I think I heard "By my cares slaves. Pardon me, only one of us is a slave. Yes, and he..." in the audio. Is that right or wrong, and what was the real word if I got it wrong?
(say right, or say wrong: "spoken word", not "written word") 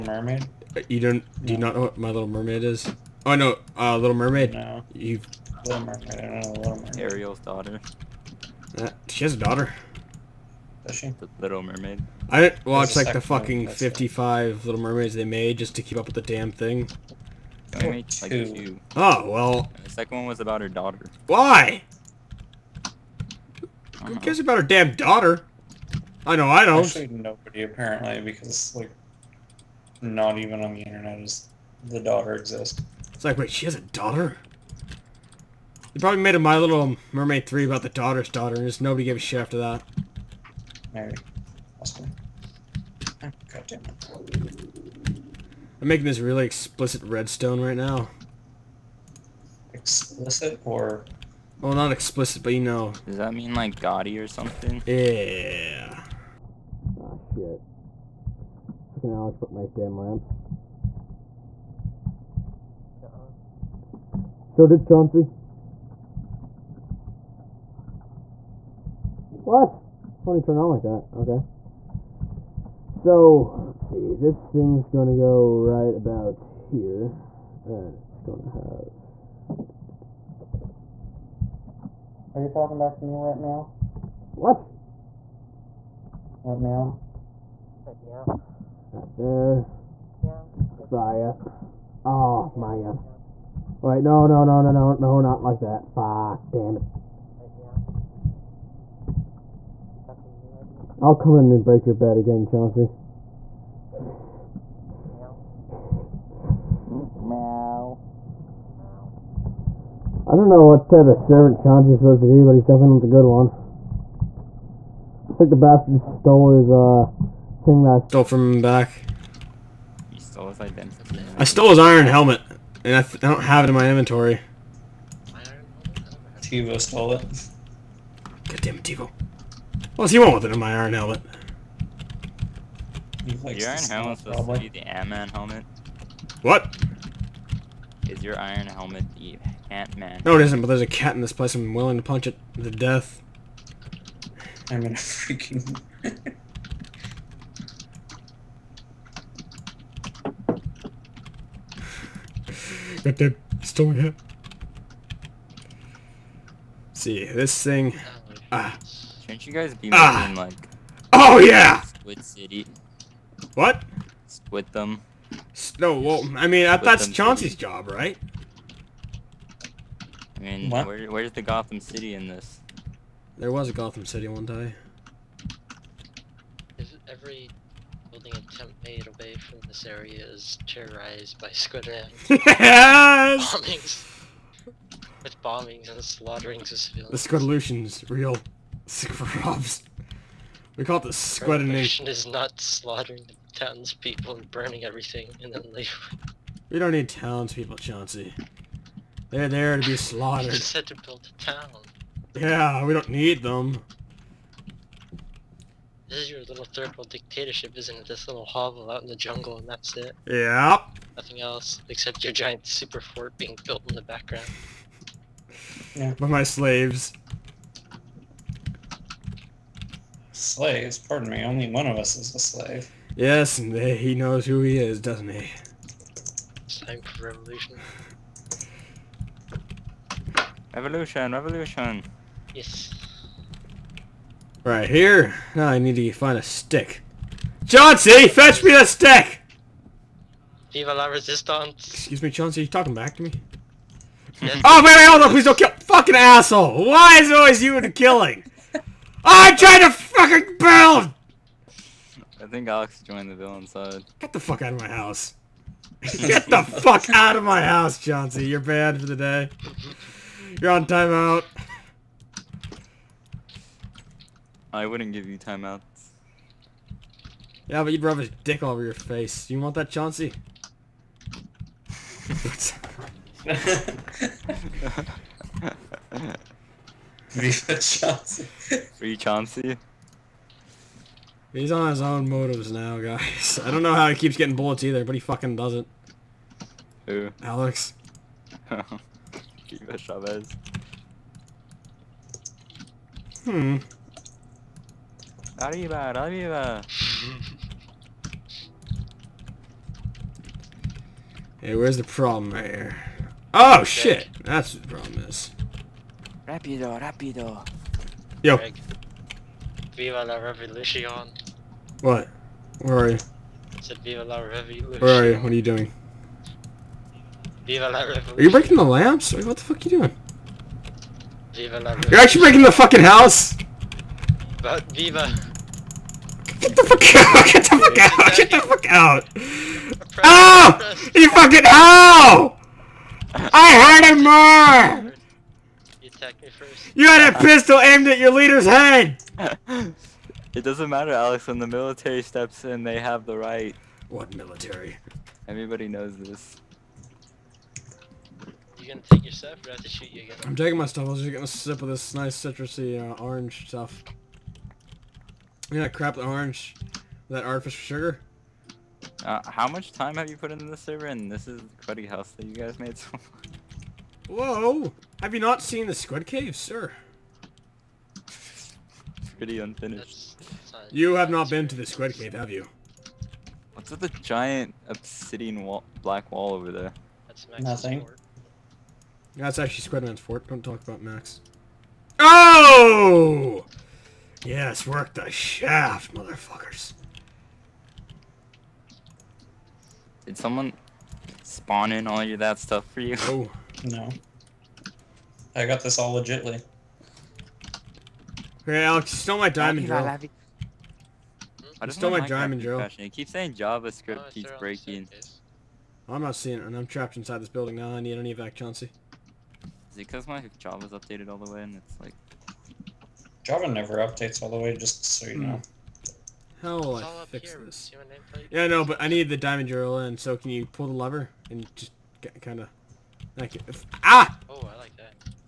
wrong: "slaves", not "cares".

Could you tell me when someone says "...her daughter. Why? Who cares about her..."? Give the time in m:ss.
0:20.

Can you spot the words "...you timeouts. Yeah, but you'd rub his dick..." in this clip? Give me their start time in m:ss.
4:25.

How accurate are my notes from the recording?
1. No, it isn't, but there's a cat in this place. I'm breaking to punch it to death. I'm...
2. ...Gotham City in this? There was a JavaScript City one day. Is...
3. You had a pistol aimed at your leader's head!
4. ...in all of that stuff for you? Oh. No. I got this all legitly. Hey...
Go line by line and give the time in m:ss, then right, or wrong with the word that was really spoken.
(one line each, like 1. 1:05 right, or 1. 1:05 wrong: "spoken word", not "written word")
1. 2:20 wrong: "willing", not "breaking"
2. 2:51 wrong: "Gotham", not "JavaScript"
3. 5:36 right
4. 6:31 right.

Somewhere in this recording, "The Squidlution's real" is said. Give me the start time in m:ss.
3:07.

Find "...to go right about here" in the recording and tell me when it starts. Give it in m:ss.
1:15.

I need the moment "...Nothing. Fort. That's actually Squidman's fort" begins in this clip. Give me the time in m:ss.
6:17.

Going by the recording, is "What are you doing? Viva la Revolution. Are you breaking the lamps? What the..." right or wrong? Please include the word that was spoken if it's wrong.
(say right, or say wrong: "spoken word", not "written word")
right.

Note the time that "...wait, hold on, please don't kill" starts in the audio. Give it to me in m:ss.
4:04.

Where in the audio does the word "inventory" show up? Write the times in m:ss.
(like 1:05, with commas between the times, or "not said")
2:03.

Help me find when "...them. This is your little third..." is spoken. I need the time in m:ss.
3:23.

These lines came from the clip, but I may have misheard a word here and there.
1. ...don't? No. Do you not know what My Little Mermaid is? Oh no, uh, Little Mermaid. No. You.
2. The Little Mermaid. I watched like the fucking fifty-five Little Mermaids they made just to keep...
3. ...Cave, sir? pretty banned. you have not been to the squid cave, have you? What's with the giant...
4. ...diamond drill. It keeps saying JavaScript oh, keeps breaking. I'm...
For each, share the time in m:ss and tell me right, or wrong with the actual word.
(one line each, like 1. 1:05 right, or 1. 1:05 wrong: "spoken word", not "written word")
1. 0:01 right
2. 0:10 right
3. 6:06 wrong: "unfinished", not "banned"
4. 6:42 right.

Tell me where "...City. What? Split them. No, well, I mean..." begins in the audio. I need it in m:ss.
2:42.